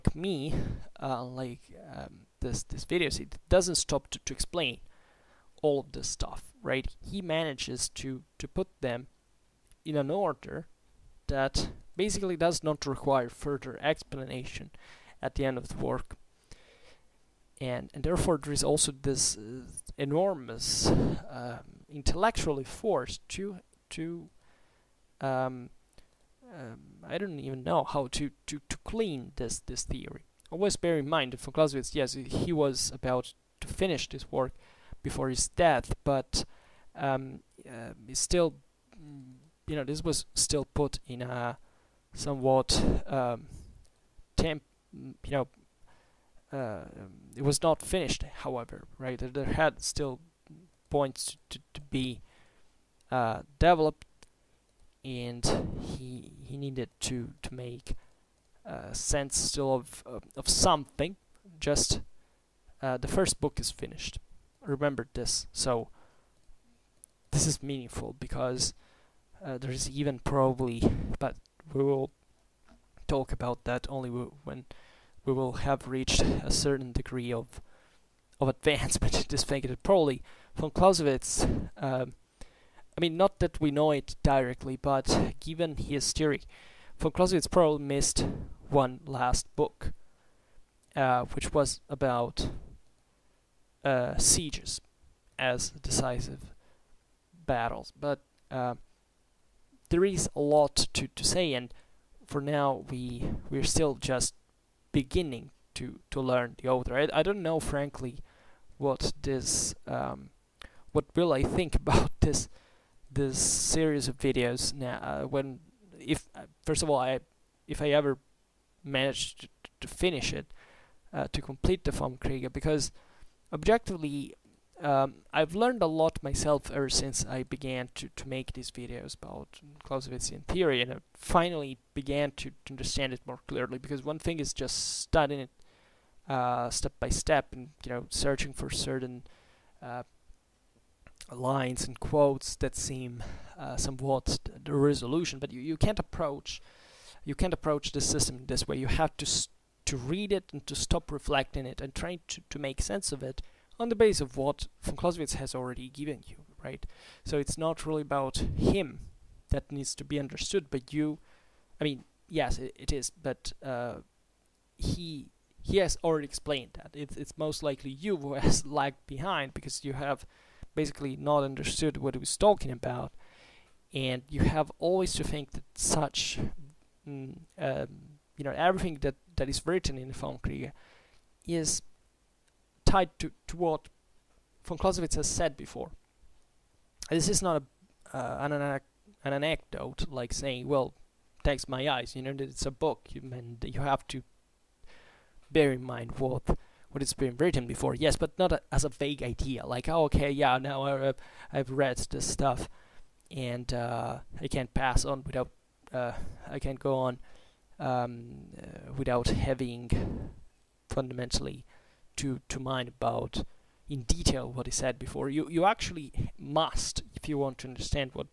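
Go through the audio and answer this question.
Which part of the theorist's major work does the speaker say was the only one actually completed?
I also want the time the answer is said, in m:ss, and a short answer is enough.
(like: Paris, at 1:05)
the first book, at 1:02.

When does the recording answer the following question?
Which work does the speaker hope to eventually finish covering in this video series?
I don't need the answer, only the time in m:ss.
2:01.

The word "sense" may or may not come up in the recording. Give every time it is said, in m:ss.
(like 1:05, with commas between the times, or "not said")
0:58, 2:32.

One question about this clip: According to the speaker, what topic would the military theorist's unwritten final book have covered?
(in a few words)
sieges as decisive battles.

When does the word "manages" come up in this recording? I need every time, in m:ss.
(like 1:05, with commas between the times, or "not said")
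0:07, 1:58.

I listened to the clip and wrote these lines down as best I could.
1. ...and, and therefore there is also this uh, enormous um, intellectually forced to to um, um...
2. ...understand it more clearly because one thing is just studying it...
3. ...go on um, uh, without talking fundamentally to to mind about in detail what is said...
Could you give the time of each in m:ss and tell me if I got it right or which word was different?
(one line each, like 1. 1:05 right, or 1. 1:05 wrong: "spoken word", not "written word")
1. 0:17 right
2. 2:12 right
3. 3:26 wrong: "having", not "talking".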